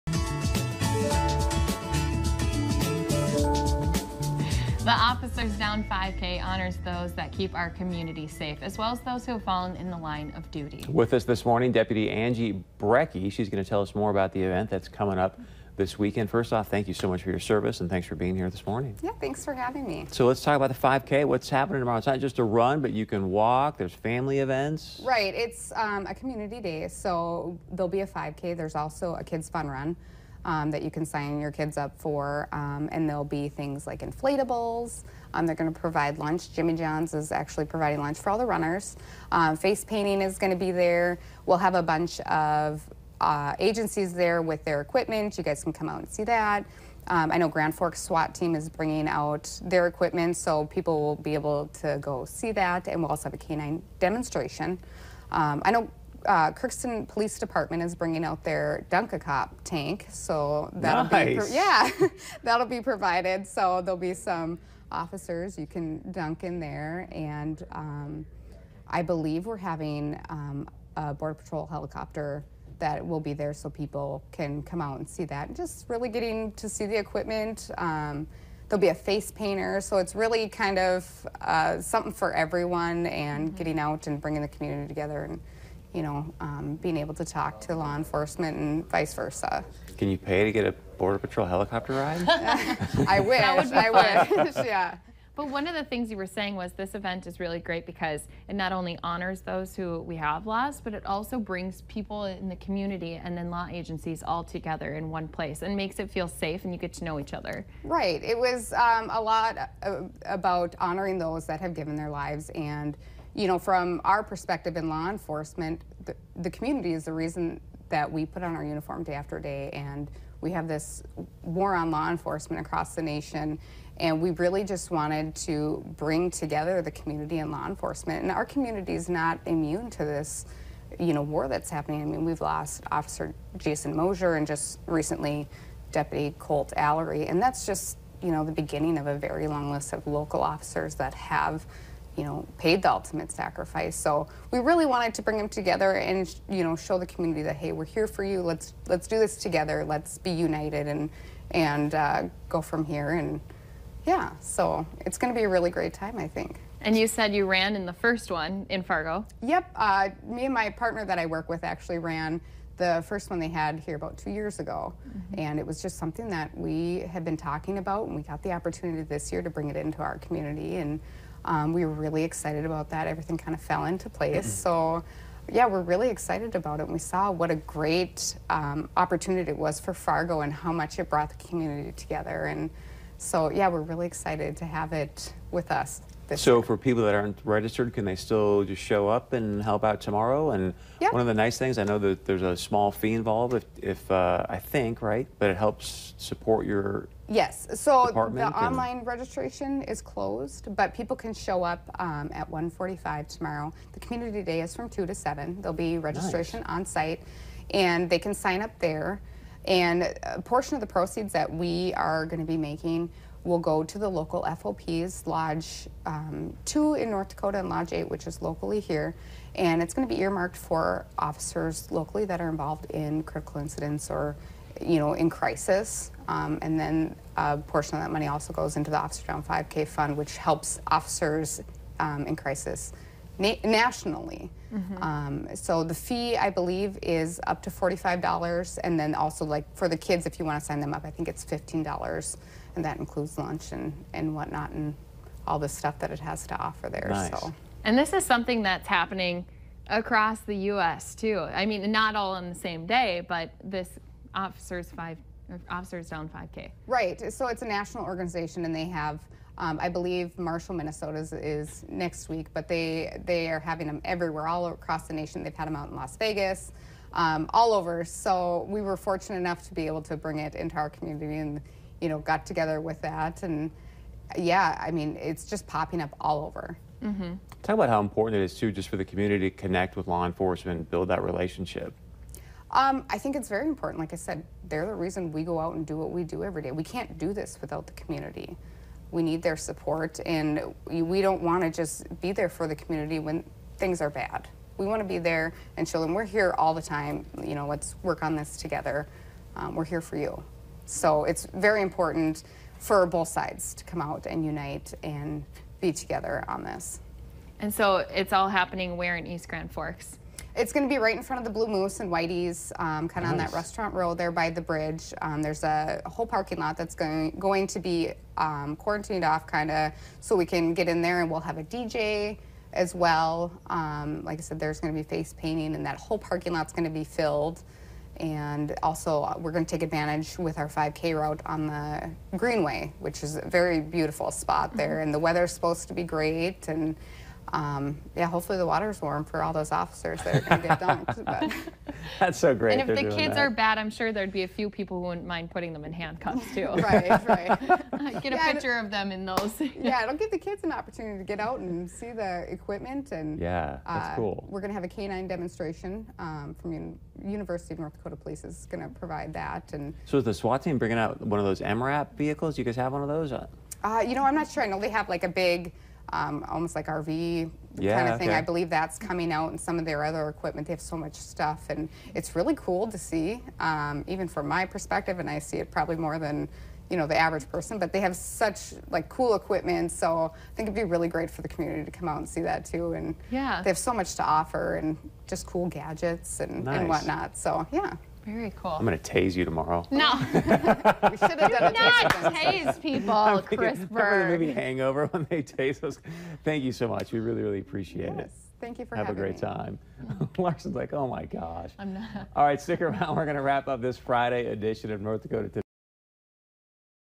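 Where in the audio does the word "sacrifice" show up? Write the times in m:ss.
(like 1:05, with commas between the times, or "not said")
2:23.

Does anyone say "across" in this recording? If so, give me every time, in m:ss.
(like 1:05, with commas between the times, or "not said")
2:02, 4:09, 4:24.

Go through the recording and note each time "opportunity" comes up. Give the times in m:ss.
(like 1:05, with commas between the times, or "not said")
2:48, 2:58, 5:50.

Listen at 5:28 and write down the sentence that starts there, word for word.
And also, uh, we're going to take advantage with our 5K route on the Greenway, which is a very beautiful spot there.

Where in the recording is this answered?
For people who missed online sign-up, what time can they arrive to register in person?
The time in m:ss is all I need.
3:22.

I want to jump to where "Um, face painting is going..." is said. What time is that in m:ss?
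0:39.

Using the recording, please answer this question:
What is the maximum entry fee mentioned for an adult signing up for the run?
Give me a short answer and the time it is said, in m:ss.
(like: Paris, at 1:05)
$45, at 3:57.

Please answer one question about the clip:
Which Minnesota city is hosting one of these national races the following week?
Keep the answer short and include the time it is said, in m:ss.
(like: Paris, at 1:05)
Marshall, at 4:20.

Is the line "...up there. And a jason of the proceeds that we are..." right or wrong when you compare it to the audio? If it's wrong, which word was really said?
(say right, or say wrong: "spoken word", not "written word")
wrong: "portion", not "jason".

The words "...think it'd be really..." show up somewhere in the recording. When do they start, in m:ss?
6:20.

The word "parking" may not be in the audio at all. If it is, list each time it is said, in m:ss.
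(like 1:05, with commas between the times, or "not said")
5:16, 5:26.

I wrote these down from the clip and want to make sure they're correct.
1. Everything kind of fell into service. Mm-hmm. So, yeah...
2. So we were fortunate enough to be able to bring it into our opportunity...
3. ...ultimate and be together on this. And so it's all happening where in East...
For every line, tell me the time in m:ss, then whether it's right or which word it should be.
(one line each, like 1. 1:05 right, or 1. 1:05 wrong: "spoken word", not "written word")
1. 2:53 wrong: "place", not "service"
2. 4:28 wrong: "community", not "opportunity"
3. 5:04 wrong: "unite", not "ultimate".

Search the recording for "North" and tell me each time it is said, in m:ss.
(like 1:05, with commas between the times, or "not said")
3:37, 5:57, 6:45.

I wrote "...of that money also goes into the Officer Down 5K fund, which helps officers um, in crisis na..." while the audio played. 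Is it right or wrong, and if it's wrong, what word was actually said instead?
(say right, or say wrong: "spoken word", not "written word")
right.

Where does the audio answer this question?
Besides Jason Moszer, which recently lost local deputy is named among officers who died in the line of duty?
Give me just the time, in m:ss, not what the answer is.
2:16.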